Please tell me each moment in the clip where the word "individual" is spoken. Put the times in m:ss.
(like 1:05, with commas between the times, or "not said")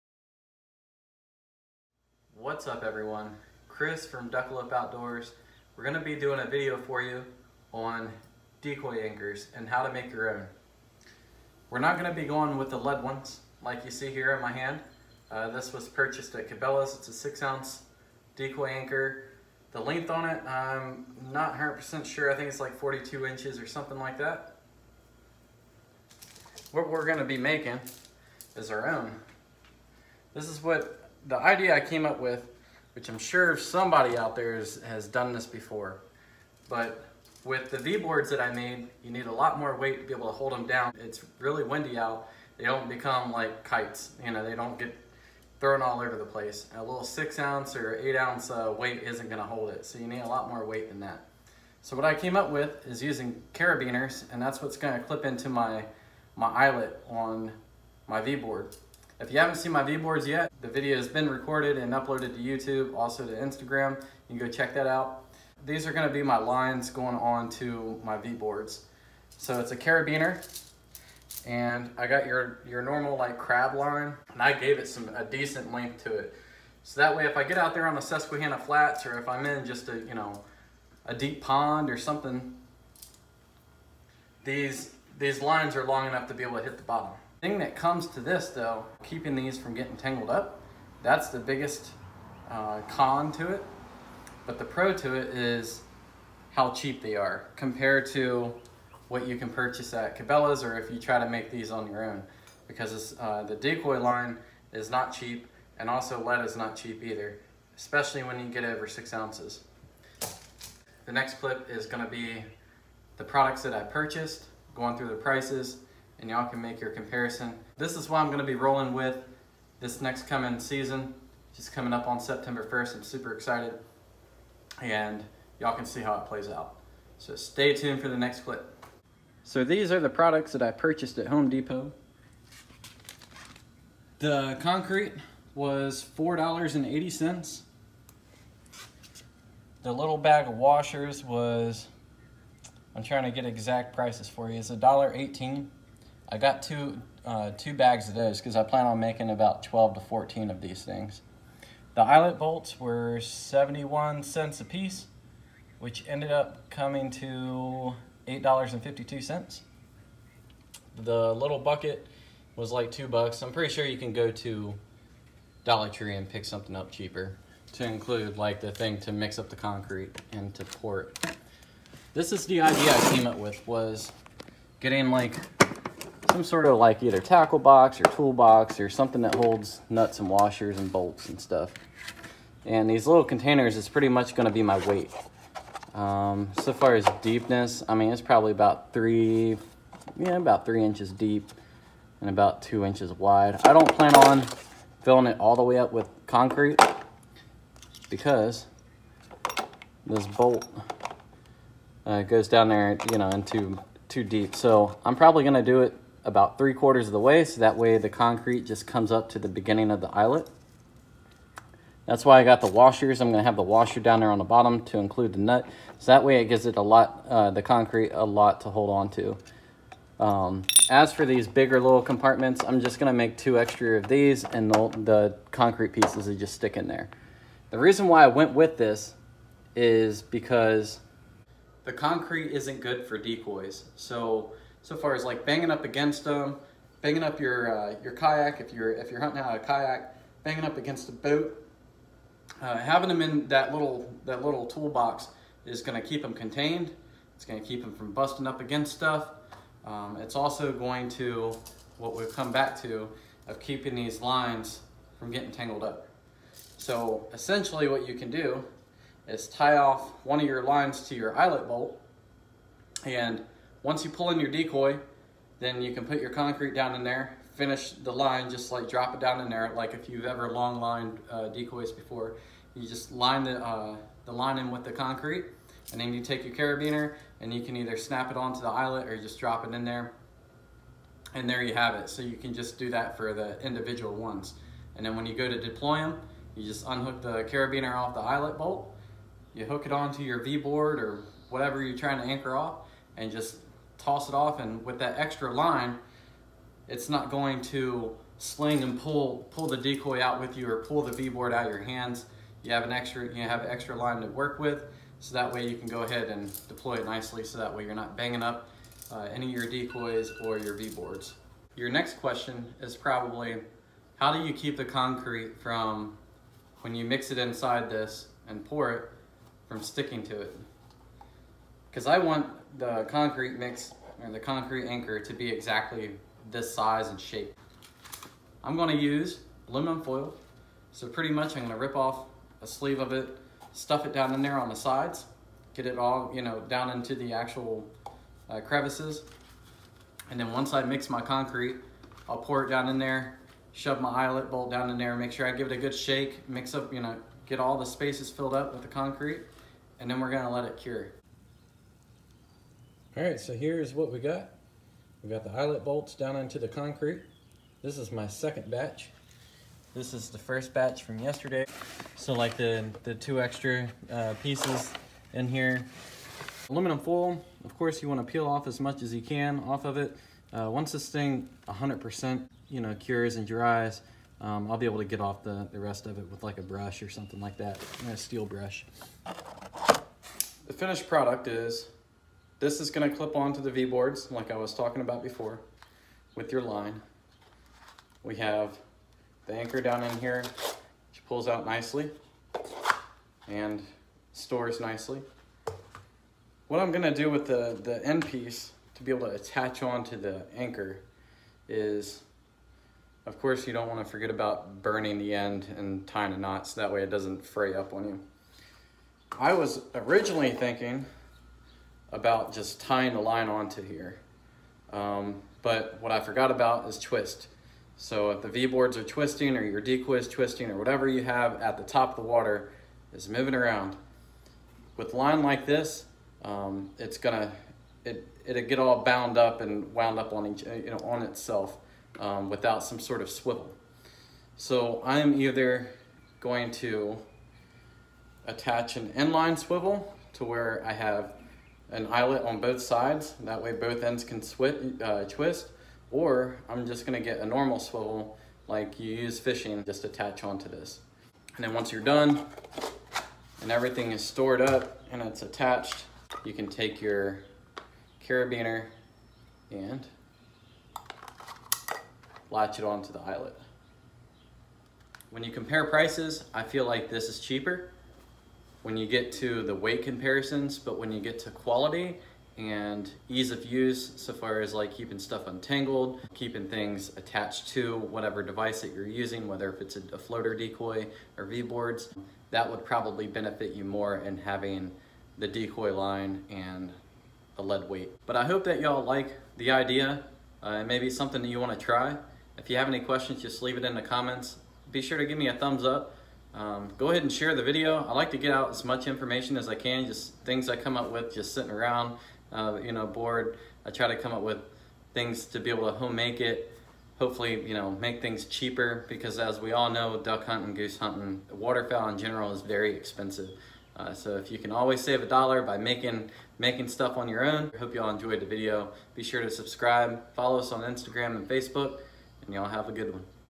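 4:43.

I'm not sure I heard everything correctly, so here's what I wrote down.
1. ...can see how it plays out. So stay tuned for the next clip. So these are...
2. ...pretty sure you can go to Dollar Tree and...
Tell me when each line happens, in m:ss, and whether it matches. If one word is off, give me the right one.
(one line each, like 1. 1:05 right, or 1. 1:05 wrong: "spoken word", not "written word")
1. 2:05 right
2. 2:43 right.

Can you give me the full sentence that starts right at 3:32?
That's why I got the washers.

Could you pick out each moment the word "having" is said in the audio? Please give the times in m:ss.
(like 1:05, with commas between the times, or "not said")
4:02, 8:04.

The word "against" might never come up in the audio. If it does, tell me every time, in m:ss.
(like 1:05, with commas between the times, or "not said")
3:55, 4:00, 4:08.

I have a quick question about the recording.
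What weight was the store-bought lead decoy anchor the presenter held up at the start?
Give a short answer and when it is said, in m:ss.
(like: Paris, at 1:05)
6 ounces, at 0:17.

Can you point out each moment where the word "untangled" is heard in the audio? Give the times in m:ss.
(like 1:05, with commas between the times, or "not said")
7:55.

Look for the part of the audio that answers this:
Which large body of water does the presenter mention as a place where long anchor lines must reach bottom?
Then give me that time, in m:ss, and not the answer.
1:18.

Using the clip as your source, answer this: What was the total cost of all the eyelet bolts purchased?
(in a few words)
$8.52.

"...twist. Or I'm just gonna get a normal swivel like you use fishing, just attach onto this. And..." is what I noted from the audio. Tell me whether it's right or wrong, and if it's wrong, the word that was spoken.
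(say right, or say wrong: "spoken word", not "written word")
right.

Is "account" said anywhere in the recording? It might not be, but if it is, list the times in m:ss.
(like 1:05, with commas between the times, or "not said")
not said.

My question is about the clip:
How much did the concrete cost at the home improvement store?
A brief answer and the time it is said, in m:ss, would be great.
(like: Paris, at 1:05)
$4.80, at 2:16.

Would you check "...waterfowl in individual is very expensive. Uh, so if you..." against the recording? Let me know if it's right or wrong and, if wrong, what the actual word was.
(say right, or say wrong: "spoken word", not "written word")
wrong: "general", not "individual".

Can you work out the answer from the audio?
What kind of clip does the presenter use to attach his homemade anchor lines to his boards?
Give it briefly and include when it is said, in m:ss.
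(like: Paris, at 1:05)
Carabiners, at 0:53.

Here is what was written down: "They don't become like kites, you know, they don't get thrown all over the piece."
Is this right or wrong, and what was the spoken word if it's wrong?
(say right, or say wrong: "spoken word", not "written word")
wrong: "place", not "piece".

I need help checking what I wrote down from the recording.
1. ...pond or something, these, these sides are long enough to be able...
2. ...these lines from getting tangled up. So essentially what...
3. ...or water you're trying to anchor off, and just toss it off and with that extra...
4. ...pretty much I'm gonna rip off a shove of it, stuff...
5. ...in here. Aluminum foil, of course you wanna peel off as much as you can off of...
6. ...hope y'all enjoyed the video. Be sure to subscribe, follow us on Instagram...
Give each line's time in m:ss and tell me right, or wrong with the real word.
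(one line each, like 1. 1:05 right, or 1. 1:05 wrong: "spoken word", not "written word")
1. 1:21 wrong: "lines", not "sides"
2. 4:13 right
3. 4:50 wrong: "whatever", not "water"
4. 5:31 wrong: "sleeve", not "shove"
5. 6:05 right
6. 8:37 right.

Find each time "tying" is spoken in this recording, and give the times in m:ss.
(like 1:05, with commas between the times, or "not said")
6:46, 6:52.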